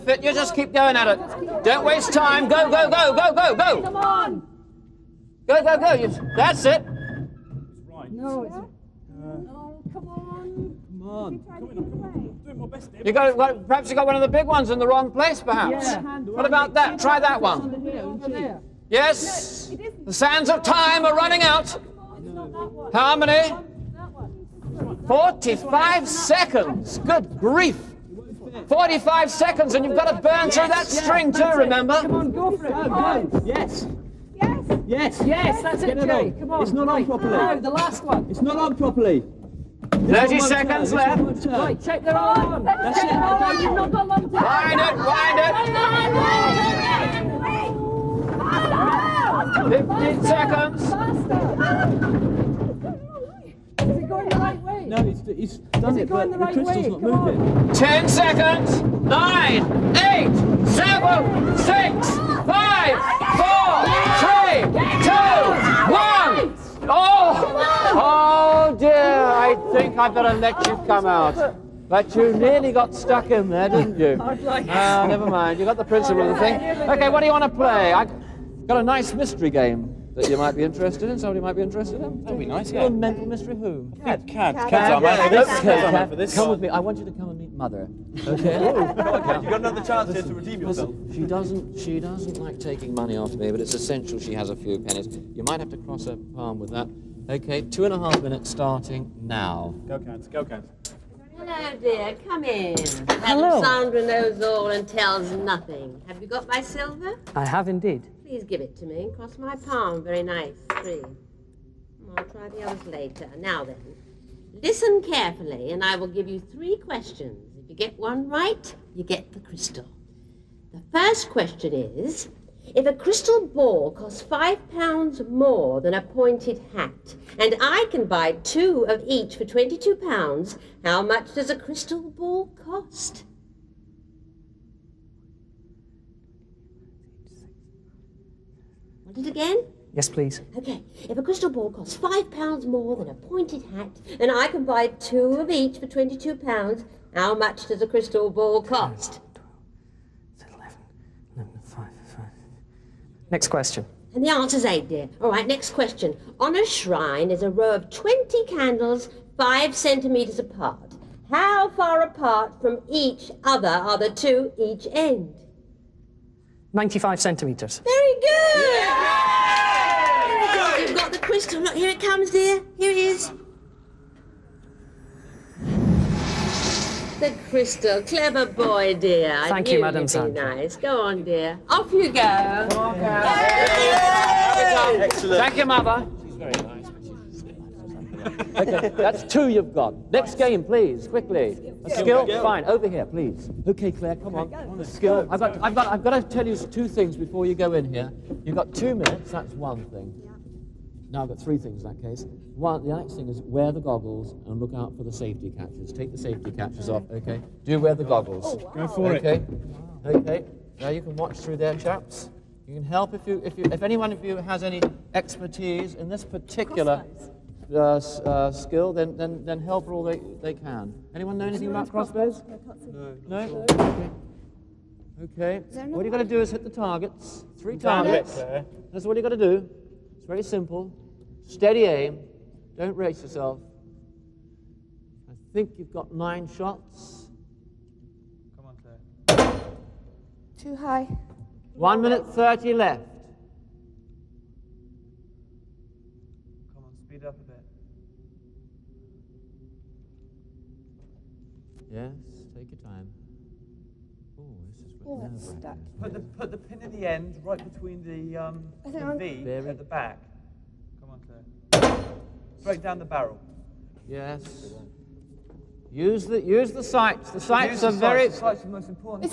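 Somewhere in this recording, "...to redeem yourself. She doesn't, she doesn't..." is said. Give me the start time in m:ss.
1:30.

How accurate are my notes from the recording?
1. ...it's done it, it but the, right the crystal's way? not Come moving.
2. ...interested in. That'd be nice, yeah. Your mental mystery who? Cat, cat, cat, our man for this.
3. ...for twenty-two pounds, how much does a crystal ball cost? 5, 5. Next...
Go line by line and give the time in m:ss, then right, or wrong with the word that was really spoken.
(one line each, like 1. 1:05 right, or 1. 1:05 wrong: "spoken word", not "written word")
1. 0:55 right
2. 1:21 right
3. 2:25 right.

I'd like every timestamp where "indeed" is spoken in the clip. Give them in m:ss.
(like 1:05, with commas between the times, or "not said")
1:47.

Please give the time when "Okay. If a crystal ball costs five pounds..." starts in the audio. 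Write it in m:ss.
2:20.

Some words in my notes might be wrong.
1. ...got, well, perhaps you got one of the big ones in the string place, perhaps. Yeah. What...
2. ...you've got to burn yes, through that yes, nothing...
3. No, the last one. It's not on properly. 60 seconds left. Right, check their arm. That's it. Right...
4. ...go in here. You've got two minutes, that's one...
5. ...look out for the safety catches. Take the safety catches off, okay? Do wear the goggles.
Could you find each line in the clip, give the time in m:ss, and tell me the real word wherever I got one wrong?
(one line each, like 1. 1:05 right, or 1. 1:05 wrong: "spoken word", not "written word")
1. 0:13 wrong: "wrong", not "string"
2. 0:29 wrong: "string", not "nothing"
3. 0:37 wrong: "30", not "60"
4. 3:17 right
5. 3:24 right.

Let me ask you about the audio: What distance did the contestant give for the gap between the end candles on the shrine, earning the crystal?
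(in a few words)
95 centimetres.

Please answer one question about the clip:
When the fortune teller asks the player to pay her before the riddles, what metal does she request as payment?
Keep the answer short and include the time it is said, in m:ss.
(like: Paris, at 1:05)
silver, at 1:46.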